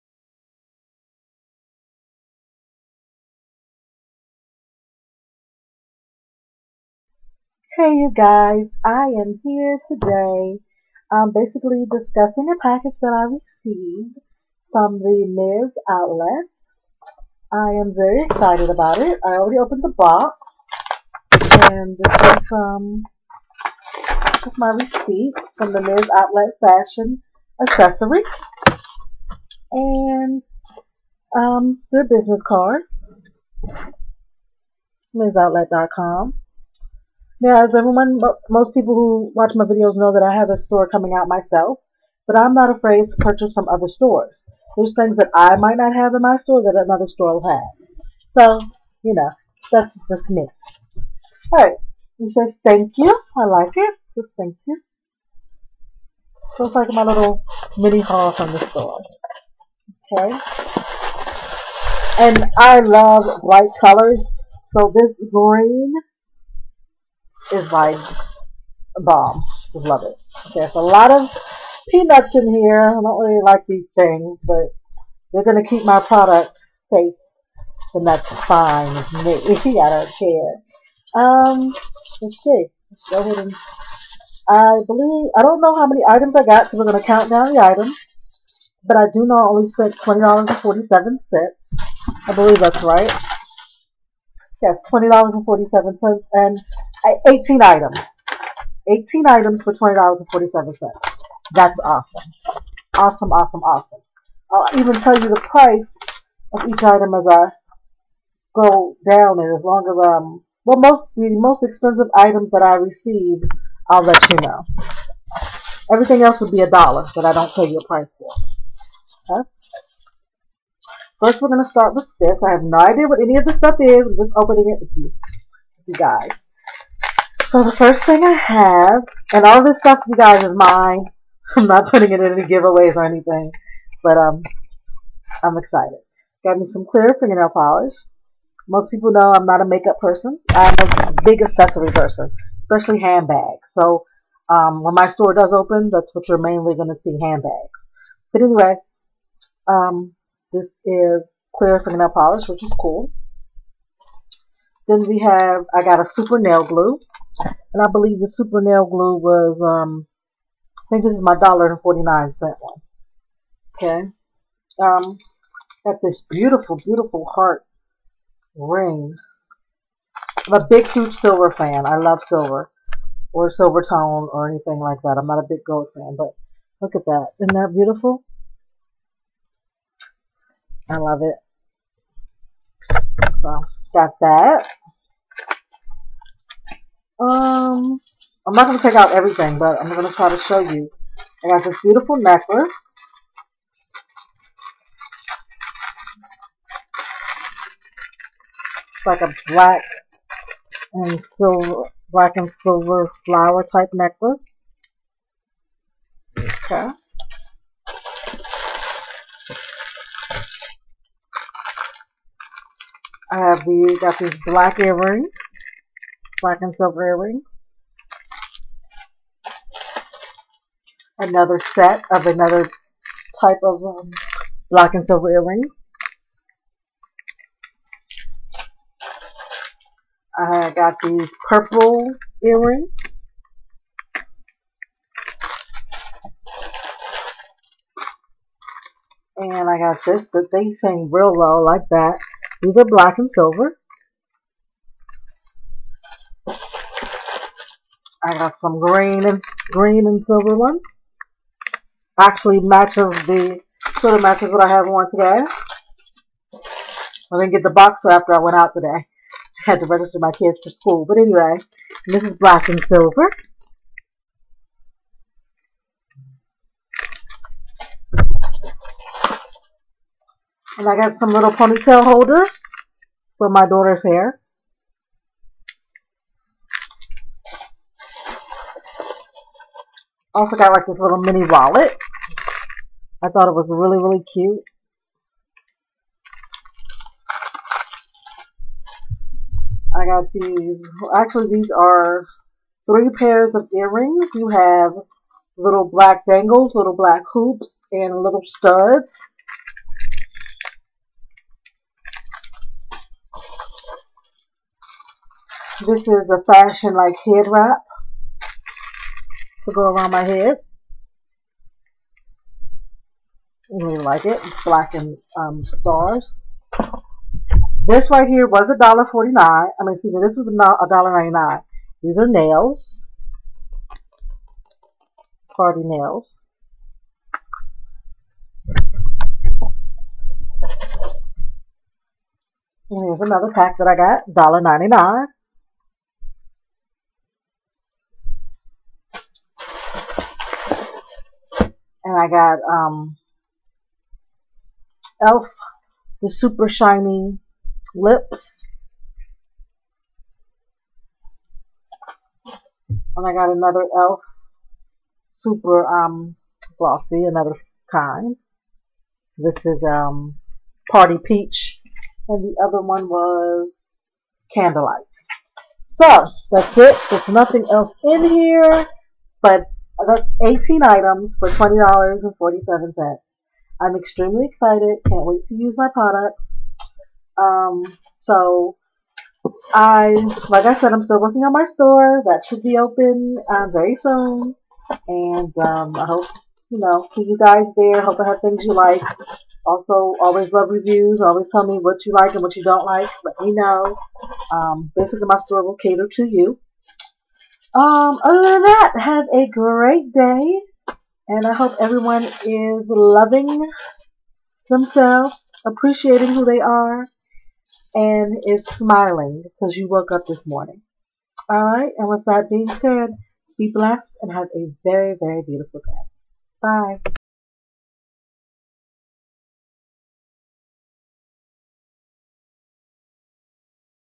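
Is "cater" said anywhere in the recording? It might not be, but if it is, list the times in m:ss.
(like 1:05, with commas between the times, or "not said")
6:35.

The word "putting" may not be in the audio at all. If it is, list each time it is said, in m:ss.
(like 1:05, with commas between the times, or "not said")
2:11.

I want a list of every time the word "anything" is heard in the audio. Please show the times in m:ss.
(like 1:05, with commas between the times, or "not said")
2:13, 2:54.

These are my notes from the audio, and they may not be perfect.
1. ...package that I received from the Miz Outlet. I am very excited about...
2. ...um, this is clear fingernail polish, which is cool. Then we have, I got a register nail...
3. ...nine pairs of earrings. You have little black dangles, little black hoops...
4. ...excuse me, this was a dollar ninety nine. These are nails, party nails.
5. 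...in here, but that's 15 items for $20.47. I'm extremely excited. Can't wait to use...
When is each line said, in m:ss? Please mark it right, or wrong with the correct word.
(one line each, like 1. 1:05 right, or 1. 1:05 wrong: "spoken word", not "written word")
1. 0:12 right
2. 2:29 wrong: "super", not "register"
3. 4:52 wrong: "three", not "nine"
4. 5:19 right
5. 6:08 wrong: "18", not "15".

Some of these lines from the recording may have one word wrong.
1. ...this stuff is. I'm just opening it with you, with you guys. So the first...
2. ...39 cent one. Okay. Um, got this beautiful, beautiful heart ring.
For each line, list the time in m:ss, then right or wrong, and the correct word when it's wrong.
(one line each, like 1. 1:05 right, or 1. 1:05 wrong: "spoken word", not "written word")
1. 2:03 right
2. 2:41 wrong: "49", not "39".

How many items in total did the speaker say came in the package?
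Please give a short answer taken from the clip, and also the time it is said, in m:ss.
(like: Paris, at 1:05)
18, at 1:36.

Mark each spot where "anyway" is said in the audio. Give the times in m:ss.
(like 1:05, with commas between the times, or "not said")
2:28, 4:21.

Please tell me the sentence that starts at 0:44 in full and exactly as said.
There's things that I might not have in my store that another store will have.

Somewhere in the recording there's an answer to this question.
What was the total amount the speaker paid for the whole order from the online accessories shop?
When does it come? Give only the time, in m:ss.
1:29.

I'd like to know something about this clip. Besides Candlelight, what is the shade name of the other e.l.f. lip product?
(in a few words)
Party Peach.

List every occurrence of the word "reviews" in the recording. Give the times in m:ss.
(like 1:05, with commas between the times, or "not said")
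6:30.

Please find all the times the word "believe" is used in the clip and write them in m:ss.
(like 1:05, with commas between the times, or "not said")
1:24, 1:32, 2:37.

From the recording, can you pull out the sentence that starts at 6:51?
All right, and with that being said, be blessed and have a very, very beautiful day.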